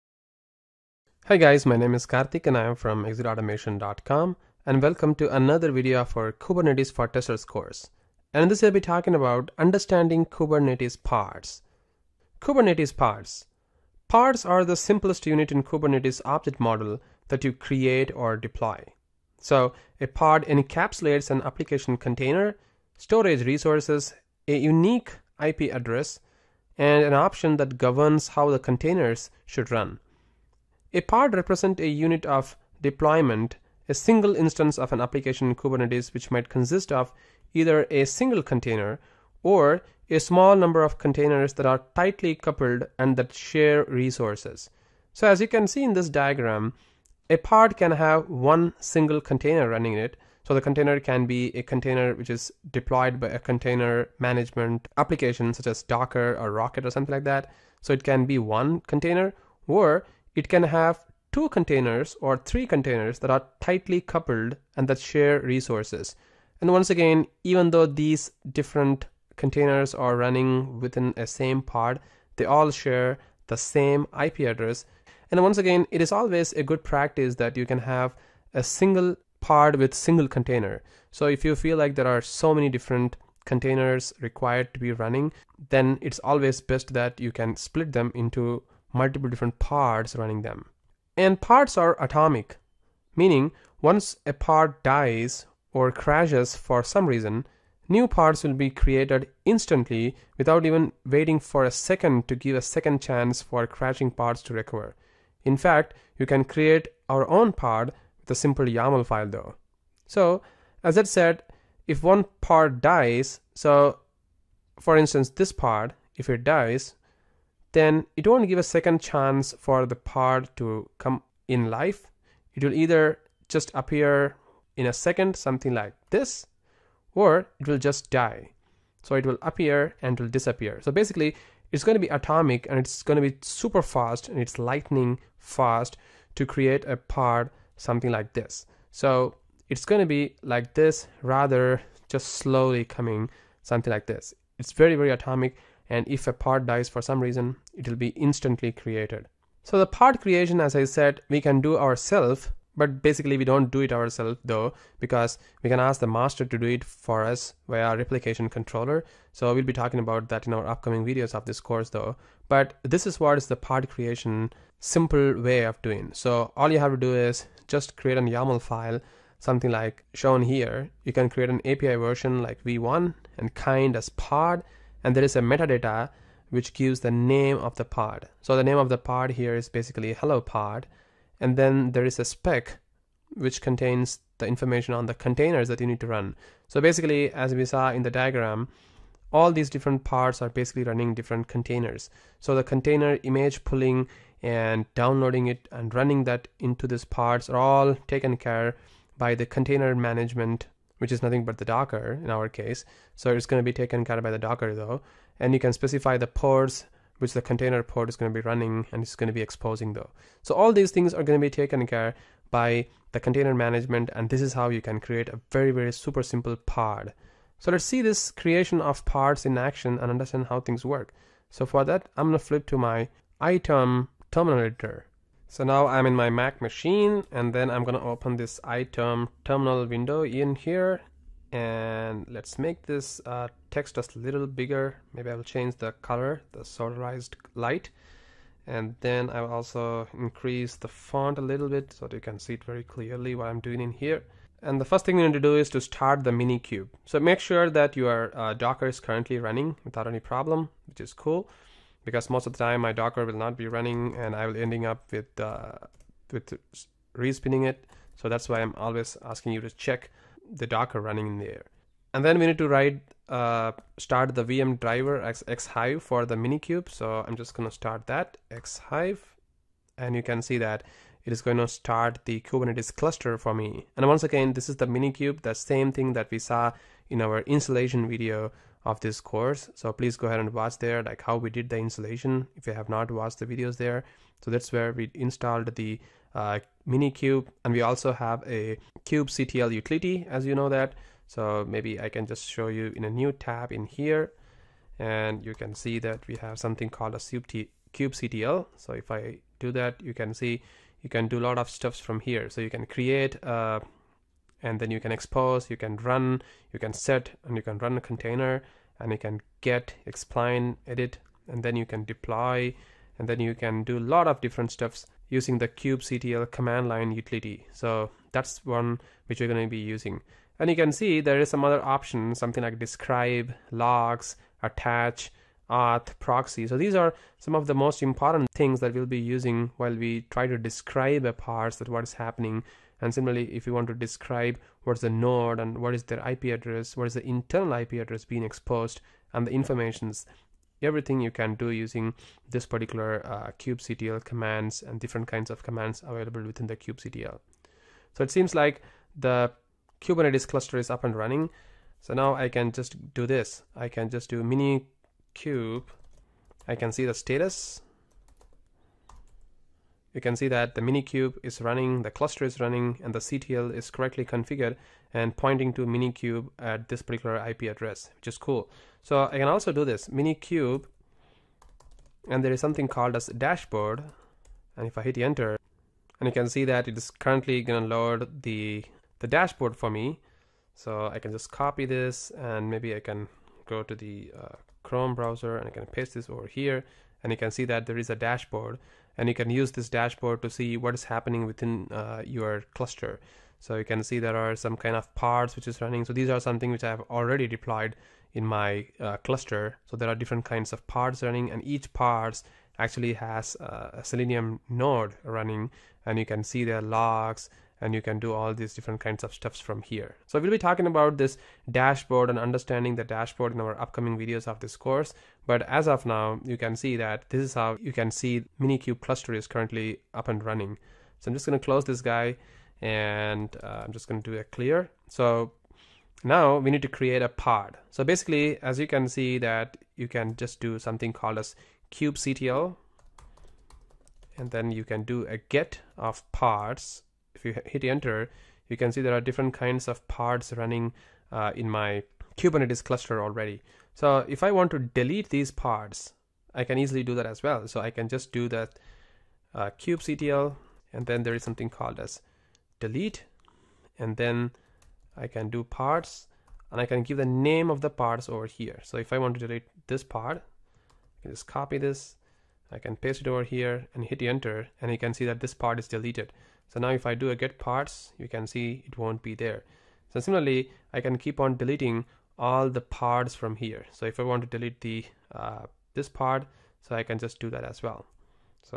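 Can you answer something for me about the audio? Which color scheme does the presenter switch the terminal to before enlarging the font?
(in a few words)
solarized light.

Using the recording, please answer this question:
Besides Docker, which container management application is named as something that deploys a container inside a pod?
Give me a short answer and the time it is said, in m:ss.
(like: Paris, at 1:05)
Rocket, at 0:56.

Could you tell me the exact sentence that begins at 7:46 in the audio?
So now if I do a get pods, you can see it won't be there.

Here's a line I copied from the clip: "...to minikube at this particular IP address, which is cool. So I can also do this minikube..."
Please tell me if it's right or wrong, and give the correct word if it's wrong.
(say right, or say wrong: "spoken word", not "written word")
right.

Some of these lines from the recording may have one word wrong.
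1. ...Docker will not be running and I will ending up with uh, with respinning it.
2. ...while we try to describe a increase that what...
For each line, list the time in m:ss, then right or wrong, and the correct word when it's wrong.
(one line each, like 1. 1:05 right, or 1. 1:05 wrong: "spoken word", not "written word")
1. 4:12 right
2. 5:29 wrong: "parse", not "increase".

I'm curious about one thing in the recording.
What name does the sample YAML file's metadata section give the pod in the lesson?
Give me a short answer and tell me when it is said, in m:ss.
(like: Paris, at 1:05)
hello pod, at 3:00.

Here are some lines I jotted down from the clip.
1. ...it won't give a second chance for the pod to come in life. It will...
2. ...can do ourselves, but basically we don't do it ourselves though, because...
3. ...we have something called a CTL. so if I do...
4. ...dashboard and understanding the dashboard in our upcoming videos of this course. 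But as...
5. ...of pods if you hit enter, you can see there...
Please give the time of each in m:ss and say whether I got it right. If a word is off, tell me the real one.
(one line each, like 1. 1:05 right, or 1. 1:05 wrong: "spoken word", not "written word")
1. 1:58 right
2. 2:31 right
3. 4:56 right
4. 6:51 right
5. 7:15 right.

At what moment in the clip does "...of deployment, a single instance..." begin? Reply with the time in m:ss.
0:32.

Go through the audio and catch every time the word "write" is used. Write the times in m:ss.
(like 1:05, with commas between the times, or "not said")
4:22.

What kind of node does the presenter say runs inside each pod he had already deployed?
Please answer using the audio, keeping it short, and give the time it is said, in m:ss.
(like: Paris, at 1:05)
Selenium node, at 6:44.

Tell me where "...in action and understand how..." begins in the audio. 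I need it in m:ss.
3:39.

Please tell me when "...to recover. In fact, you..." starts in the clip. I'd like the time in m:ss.
1:44.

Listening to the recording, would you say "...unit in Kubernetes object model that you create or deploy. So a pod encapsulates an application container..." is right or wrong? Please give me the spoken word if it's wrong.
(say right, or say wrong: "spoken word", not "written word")
right.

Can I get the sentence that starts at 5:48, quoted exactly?
So it seems like the Kubernetes cluster is up and running.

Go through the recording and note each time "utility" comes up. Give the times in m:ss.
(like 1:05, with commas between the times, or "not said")
4:49, 5:17.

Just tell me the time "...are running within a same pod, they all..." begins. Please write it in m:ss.
1:09.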